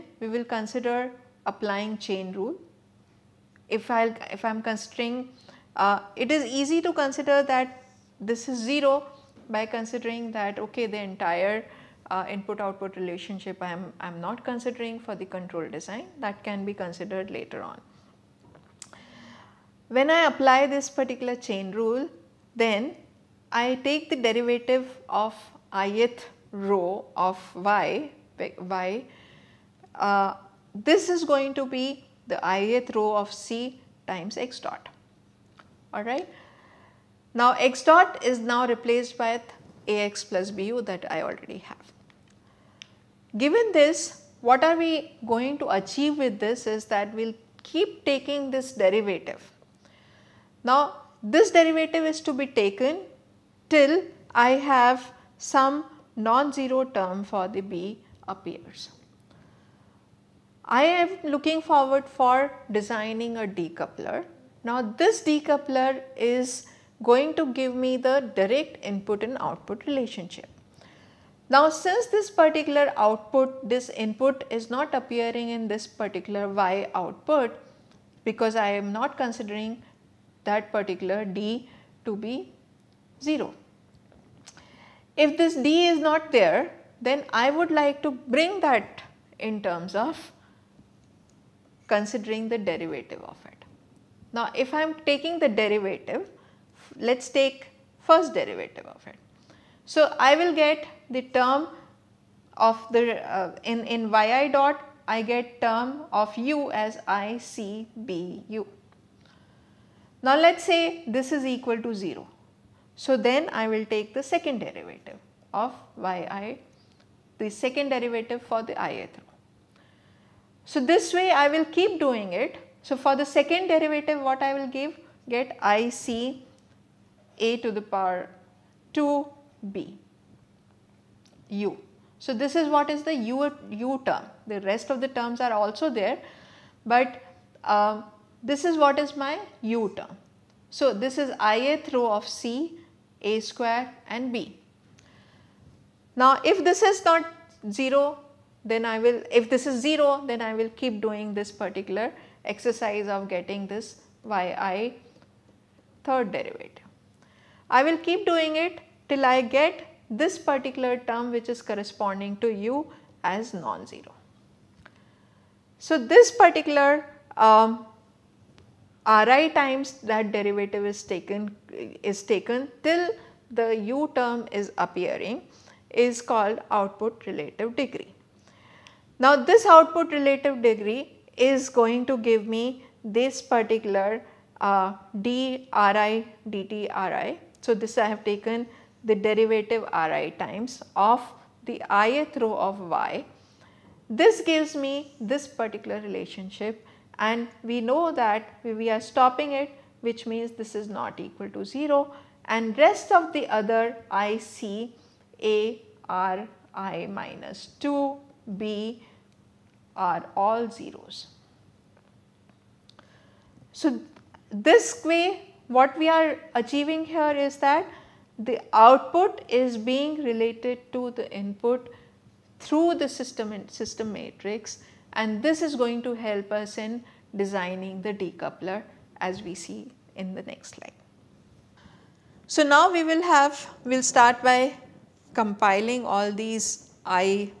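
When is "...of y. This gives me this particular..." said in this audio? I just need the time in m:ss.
3:12.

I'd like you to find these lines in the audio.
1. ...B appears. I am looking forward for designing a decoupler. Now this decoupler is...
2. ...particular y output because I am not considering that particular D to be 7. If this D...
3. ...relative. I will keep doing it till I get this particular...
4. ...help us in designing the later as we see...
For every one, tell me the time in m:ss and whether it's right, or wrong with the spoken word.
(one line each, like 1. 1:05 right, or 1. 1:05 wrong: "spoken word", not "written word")
1. 0:57 right
2. 1:15 wrong: "0", not "7"
3. 2:36 wrong: "derivative", not "relative"
4. 3:46 wrong: "decoupler", not "later".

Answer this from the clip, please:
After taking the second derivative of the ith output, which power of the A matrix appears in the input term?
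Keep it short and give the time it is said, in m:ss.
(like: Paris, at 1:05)
2, at 2:05.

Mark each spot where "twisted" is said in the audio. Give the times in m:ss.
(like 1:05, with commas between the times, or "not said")
not said.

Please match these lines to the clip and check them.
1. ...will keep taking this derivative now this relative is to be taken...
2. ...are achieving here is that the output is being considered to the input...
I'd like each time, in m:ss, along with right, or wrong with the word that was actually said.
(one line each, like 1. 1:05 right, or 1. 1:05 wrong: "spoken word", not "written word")
1. 0:47 wrong: "derivative", not "relative"
2. 3:36 wrong: "related", not "considered".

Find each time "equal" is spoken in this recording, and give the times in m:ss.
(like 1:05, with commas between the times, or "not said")
1:51, 3:21.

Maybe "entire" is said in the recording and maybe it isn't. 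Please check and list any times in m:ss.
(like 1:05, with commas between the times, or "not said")
0:10.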